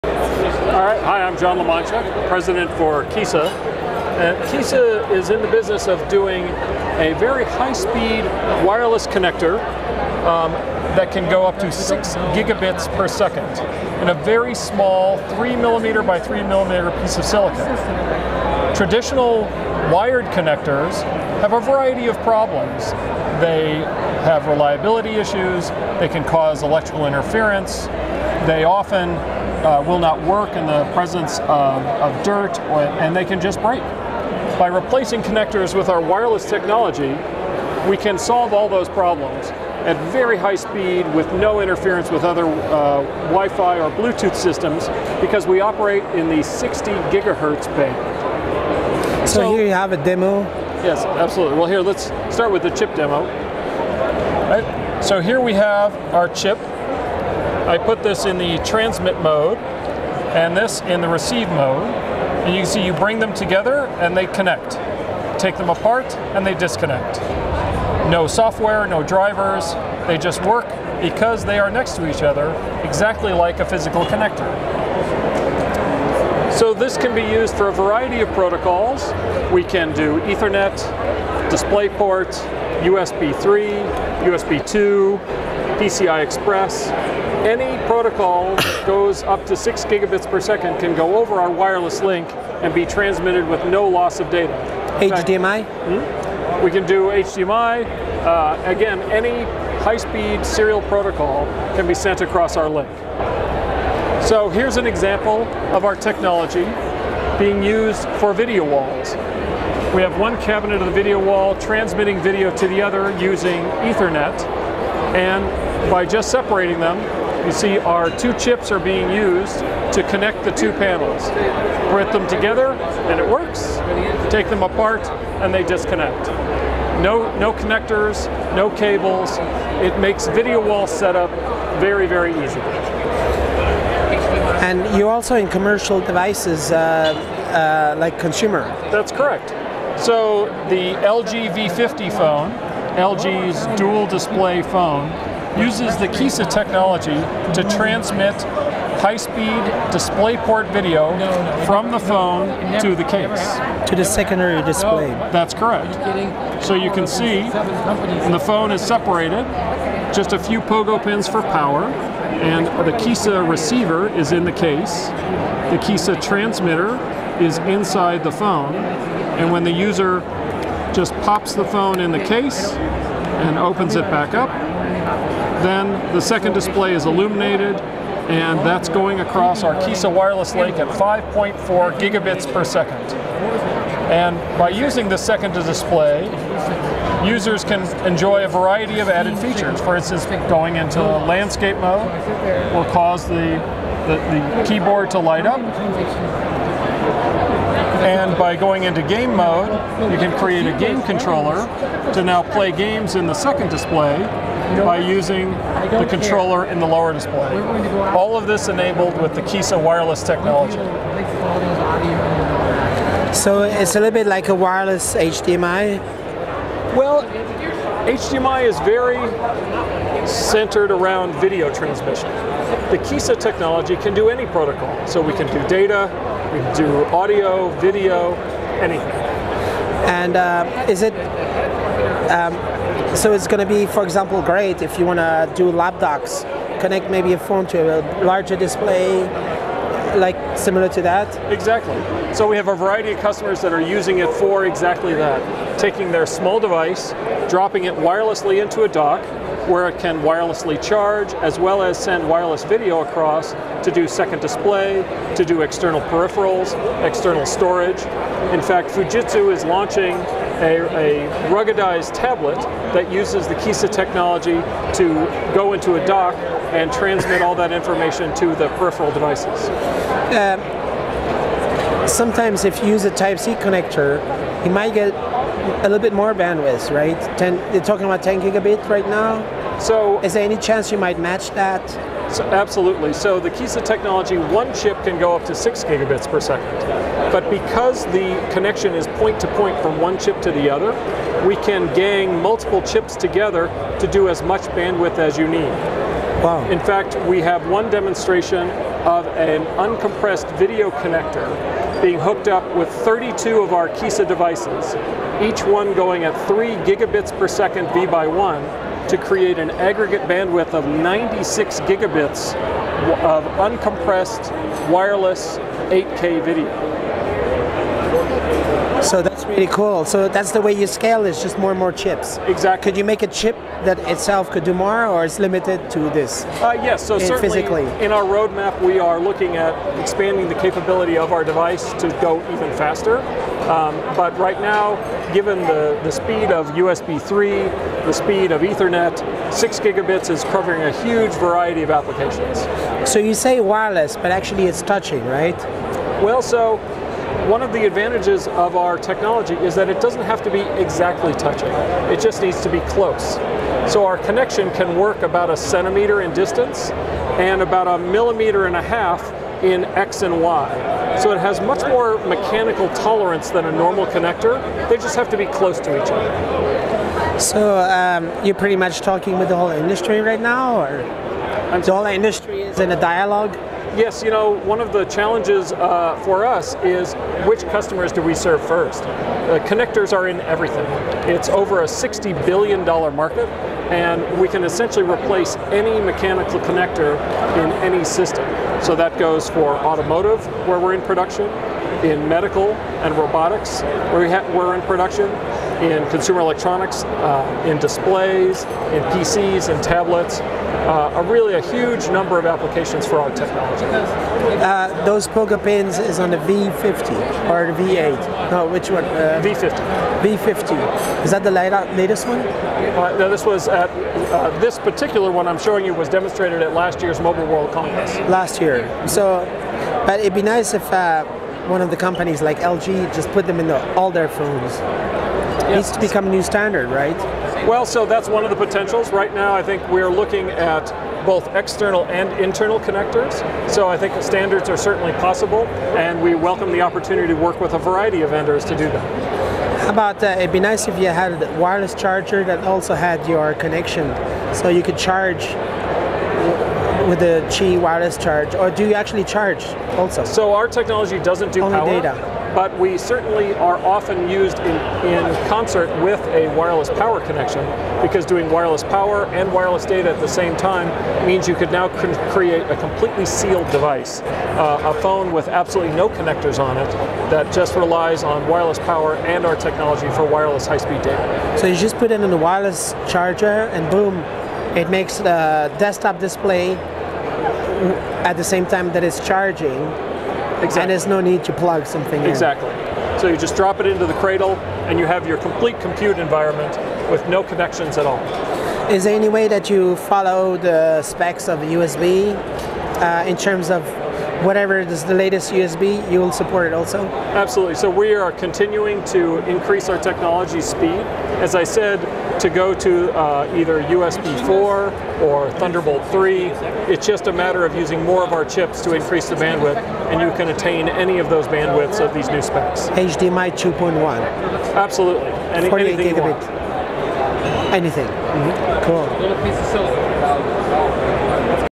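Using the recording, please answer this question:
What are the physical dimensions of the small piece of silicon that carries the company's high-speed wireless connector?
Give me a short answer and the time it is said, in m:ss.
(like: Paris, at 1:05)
3 millimeter by 3 millimeter, at 0:15.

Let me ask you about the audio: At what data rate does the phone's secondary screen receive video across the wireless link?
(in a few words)
5.4 gigabits per second.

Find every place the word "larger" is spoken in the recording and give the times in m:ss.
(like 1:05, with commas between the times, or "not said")
3:58.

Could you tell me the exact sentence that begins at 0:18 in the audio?
Traditional wired connectors have a variety of problems.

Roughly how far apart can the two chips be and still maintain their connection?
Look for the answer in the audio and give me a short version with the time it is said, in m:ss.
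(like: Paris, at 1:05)
about a centimeter, at 5:55.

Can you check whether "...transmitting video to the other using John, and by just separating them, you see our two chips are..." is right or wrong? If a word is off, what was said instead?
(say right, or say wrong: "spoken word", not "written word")
wrong: "Ethernet", not "John".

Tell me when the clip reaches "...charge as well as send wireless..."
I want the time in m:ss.
4:10.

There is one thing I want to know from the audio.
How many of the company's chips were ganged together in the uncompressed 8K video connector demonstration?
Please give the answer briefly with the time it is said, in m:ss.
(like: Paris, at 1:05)
32, at 5:02.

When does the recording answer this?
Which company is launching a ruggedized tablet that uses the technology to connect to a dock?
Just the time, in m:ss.
4:18.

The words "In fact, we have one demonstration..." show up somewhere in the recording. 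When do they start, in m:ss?
4:56.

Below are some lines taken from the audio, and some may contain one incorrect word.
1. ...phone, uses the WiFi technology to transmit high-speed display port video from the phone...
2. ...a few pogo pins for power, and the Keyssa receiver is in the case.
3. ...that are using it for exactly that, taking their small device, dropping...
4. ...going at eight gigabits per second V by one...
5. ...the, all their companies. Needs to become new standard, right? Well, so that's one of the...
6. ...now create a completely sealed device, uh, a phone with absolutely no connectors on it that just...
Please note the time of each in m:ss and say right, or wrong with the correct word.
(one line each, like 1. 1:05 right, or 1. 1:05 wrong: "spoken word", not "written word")
1. 2:24 wrong: "Keyssa", not "WiFi"
2. 2:40 right
3. 4:03 right
4. 5:05 wrong: "three", not "eight"
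5. 7:03 wrong: "phones", not "companies"
6. 7:41 right.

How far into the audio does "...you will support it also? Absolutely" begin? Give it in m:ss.
8:16.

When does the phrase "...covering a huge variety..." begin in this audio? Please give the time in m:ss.
5:40.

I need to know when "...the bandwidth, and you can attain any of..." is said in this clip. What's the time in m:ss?
8:29.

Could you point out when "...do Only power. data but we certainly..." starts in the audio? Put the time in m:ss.
7:31.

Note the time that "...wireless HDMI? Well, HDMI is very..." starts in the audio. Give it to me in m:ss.
3:34.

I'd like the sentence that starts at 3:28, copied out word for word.
All of this enabled with the Keyssa wireless technology.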